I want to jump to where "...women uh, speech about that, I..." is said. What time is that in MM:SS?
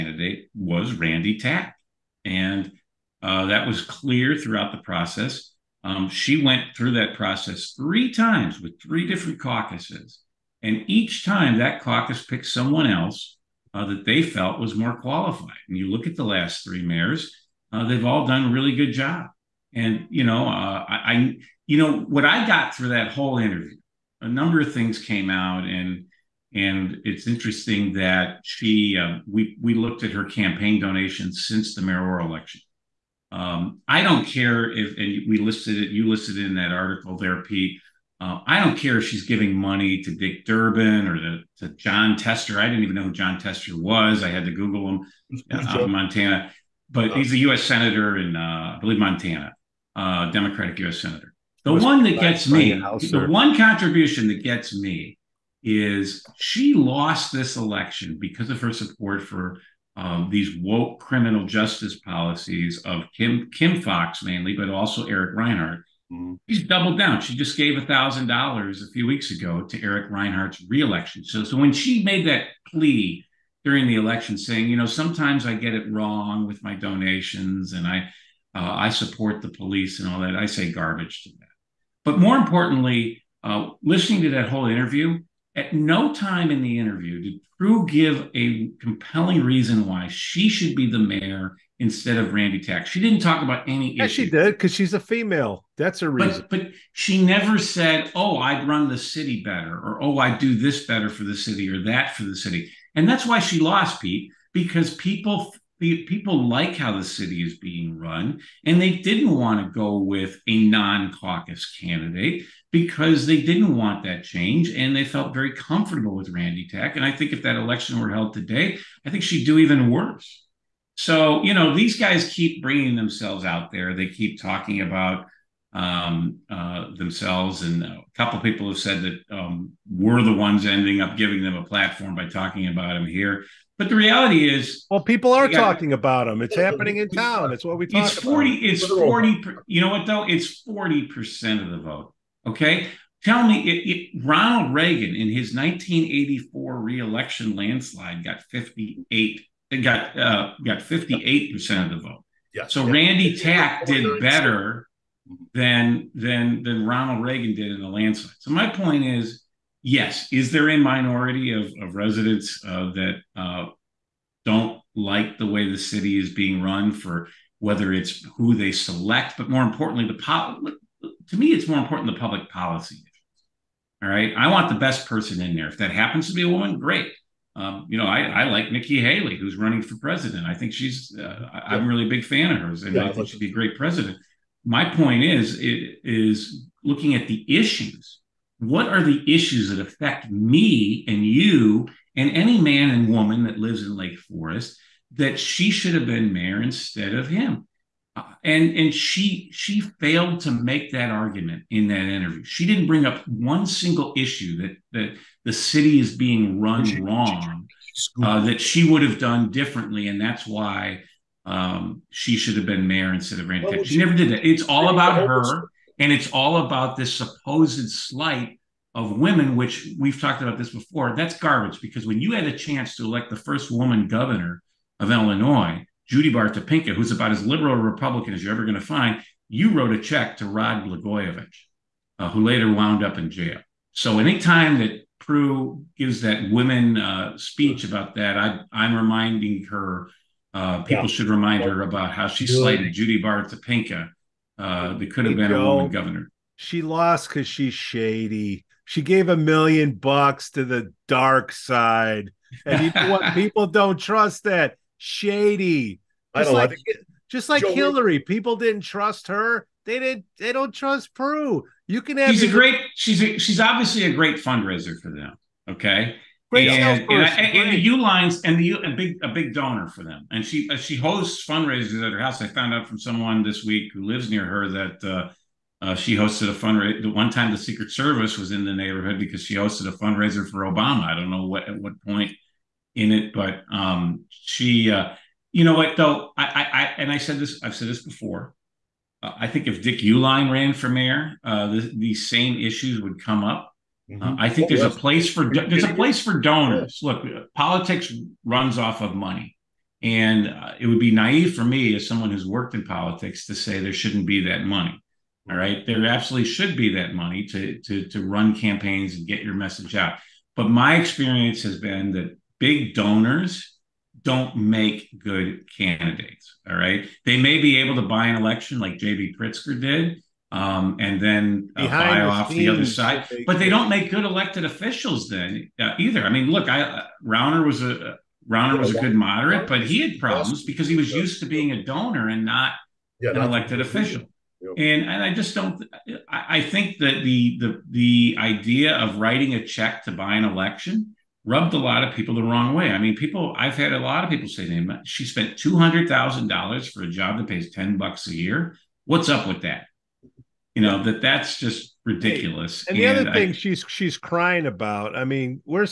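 03:56.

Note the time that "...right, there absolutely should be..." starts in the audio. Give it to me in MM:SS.
05:05.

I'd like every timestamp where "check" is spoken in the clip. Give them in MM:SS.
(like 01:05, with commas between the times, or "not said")
03:49, 05:39.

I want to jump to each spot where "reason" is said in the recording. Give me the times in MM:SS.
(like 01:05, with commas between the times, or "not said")
01:29, 01:36.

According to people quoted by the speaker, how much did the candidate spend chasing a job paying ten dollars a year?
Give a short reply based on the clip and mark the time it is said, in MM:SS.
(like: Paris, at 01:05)
$200,000, at 05:45.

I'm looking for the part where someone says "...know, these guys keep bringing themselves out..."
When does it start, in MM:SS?
02:01.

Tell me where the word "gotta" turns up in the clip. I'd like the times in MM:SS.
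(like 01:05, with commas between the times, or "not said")
02:15.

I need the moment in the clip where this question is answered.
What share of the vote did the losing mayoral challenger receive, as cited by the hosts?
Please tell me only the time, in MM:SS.
02:20.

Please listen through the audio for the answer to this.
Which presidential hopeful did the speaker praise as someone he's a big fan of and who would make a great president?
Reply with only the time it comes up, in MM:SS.
02:58.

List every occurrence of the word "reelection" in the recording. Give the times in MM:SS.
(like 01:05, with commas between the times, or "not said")
01:10, 02:26.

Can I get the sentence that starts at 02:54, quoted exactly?
All right, I want the best person in there.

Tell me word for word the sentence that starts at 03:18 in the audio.
Uh, and and she she failed to make that argument in that interview.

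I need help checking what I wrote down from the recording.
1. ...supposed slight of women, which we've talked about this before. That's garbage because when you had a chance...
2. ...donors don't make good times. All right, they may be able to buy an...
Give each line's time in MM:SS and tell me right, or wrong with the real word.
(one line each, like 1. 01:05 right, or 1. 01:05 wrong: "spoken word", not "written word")
1. 03:37 right
2. 05:12 wrong: "candidates", not "times".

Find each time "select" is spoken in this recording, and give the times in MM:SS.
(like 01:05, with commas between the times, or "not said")
02:48.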